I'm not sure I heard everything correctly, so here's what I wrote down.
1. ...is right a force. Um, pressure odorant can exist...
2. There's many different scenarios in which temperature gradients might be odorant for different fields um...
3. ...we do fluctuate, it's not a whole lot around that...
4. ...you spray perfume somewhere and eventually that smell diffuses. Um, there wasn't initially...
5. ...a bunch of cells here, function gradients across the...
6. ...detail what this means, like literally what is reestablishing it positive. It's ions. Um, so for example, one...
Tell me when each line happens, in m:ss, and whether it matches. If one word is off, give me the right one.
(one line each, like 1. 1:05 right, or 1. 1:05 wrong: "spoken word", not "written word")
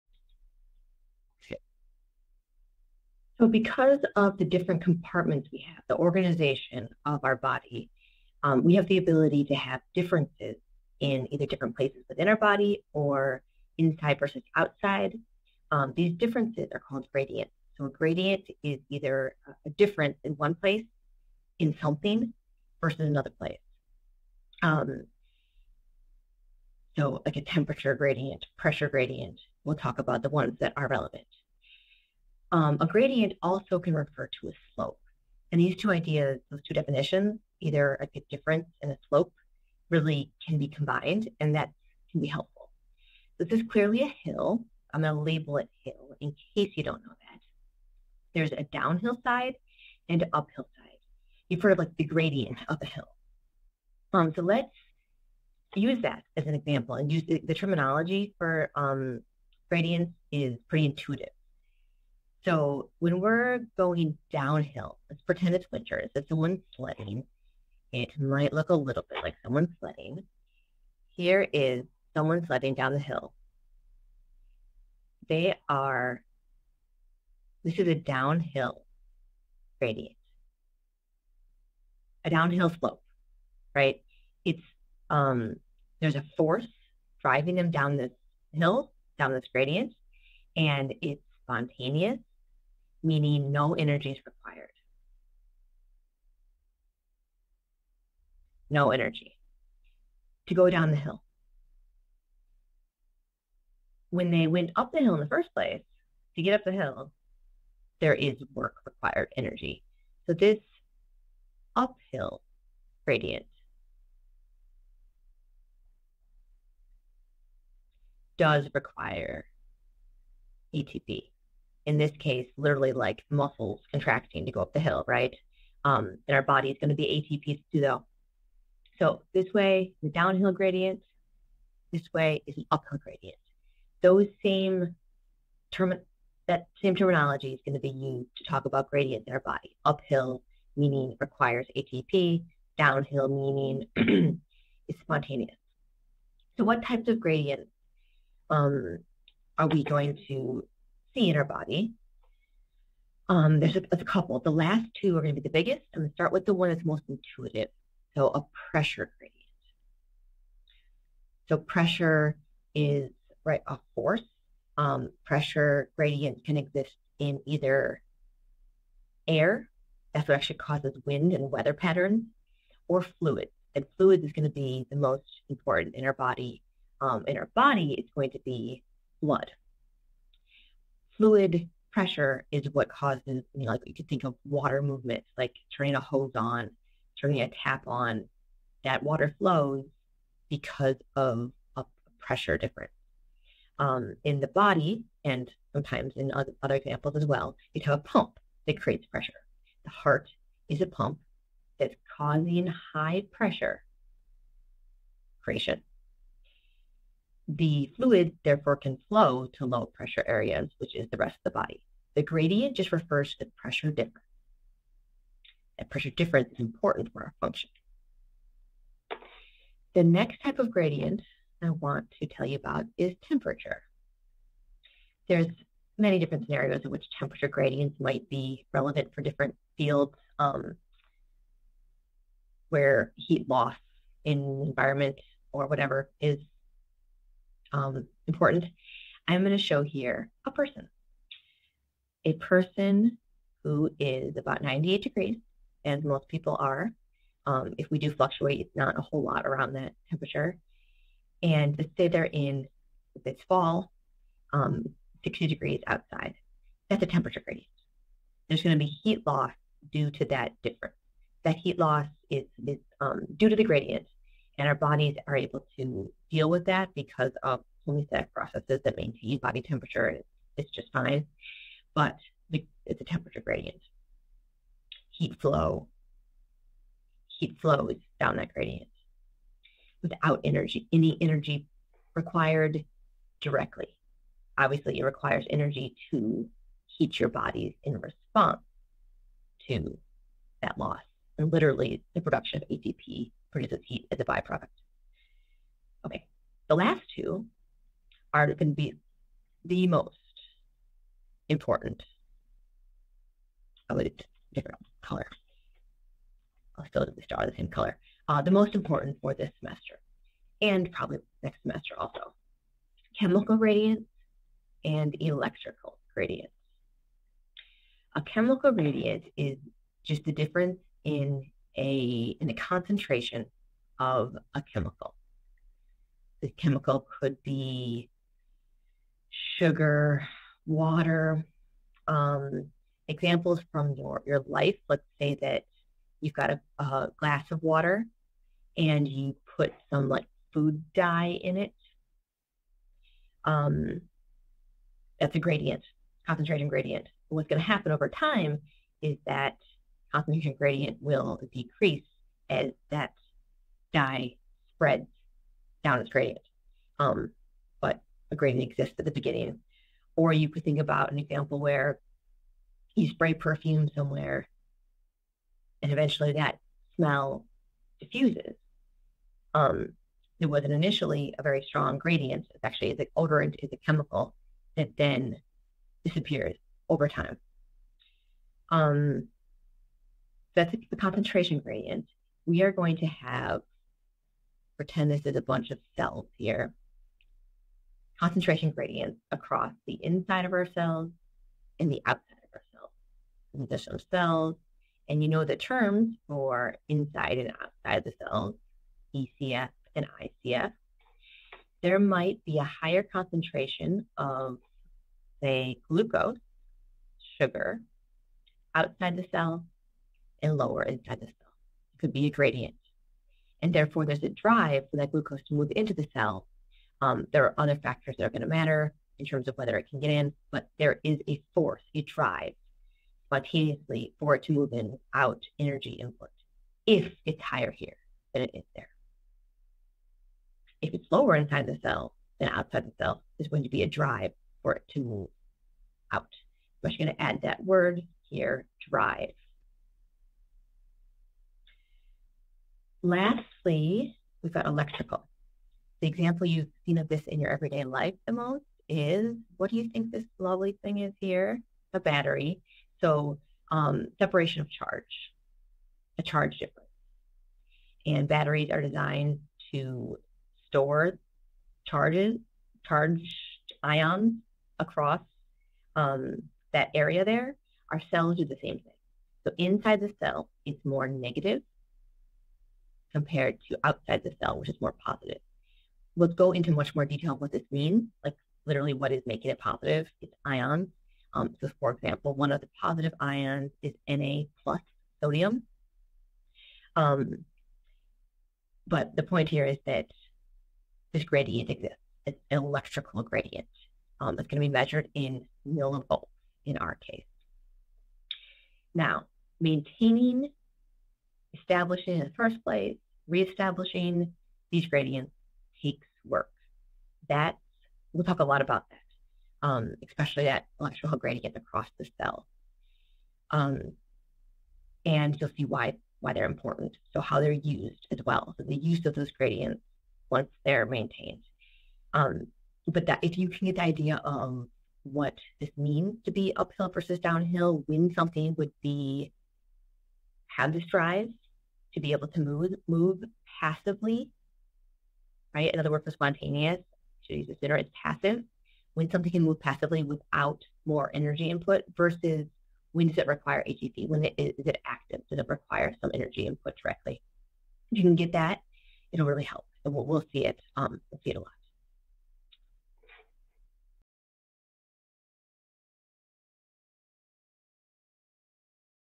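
1. 2:42 wrong: "gradient", not "odorant"
2. 3:45 wrong: "relevant", not "odorant"
3. 4:07 right
4. 6:02 right
5. 6:25 wrong: "concentration", not "function"
6. 7:57 wrong: "making", not "reestablishing".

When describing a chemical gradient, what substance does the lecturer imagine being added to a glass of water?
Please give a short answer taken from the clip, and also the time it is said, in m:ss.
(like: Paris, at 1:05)
Food dye, at 5:40.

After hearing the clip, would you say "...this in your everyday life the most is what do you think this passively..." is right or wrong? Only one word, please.
wrong.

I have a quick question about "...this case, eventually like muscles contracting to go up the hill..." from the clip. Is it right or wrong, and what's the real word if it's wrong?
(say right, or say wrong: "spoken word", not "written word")
wrong: "literally", not "eventually".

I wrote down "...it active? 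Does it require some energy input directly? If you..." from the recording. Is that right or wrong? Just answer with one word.
right.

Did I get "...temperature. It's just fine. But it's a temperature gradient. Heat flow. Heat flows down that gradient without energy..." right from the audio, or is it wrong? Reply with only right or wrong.
right.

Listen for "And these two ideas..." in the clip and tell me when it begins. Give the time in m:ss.
0:35.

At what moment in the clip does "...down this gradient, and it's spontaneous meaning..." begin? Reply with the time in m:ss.
1:29.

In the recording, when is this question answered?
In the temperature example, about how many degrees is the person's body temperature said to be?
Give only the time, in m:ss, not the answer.
4:04.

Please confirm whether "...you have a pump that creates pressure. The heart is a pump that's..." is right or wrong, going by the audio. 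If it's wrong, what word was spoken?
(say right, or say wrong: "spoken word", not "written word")
right.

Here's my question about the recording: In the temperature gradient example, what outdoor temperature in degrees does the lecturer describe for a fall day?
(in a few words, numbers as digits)
60 degrees.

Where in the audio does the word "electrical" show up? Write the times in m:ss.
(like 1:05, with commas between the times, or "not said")
5:15, 7:24, 8:12, 8:30.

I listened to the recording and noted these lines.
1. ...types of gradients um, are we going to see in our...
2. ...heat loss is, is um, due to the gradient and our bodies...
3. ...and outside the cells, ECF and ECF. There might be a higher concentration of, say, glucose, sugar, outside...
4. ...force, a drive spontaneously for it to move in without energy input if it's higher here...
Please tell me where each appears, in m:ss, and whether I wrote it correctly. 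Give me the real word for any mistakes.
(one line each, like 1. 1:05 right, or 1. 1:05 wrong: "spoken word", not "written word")
1. 2:26 right
2. 4:21 right
3. 6:37 wrong: "ICF", not "ECF"
4. 7:01 right.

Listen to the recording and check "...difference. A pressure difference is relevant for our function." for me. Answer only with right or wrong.
wrong.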